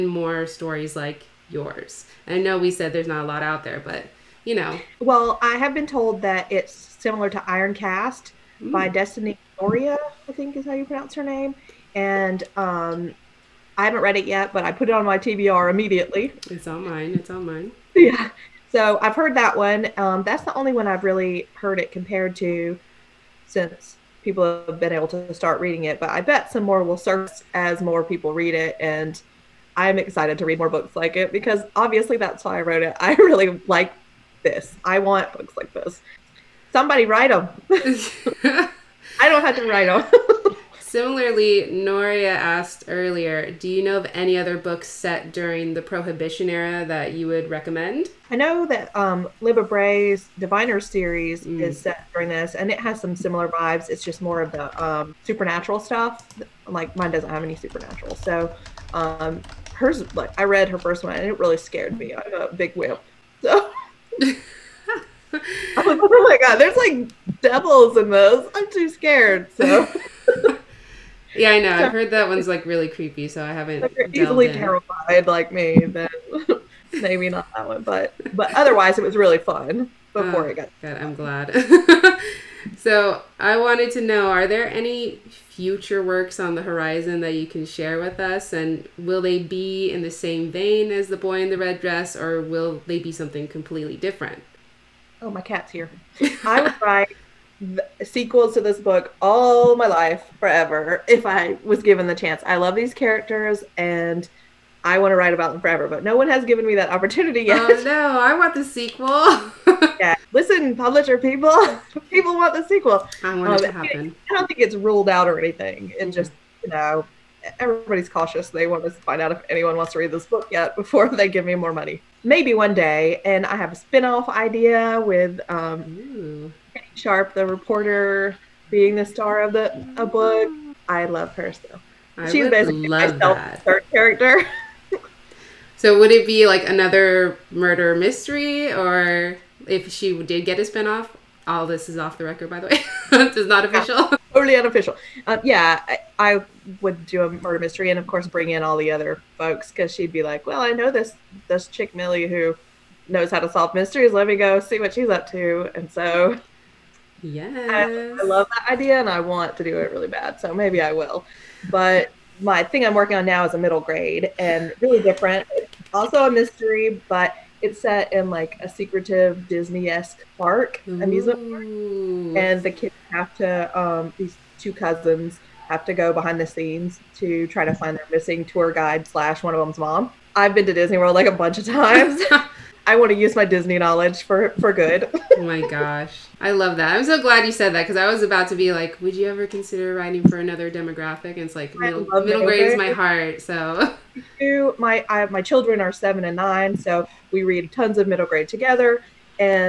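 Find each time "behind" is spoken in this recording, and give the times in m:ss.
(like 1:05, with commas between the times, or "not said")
2:56.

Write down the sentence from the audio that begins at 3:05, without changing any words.
oh my gosh, I love that.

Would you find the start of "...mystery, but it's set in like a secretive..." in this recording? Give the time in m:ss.
2:46.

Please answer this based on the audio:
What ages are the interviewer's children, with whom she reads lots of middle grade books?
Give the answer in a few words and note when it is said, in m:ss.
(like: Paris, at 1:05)
7 and 9, at 3:15.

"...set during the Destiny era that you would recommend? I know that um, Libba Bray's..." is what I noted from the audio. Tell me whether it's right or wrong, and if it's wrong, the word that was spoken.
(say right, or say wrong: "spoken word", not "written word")
wrong: "Prohibition", not "Destiny".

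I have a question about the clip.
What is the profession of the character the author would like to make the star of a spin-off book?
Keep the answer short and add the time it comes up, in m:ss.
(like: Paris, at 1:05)
Reporter, at 2:07.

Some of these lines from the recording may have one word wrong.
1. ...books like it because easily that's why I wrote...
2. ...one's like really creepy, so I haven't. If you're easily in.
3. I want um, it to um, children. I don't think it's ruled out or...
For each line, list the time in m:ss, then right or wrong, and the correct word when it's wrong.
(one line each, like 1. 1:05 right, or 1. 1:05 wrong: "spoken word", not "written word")
1. 0:30 wrong: "obviously", not "easily"
2. 1:12 right
3. 1:53 wrong: "happen", not "children".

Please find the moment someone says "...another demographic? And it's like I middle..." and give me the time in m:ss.
3:10.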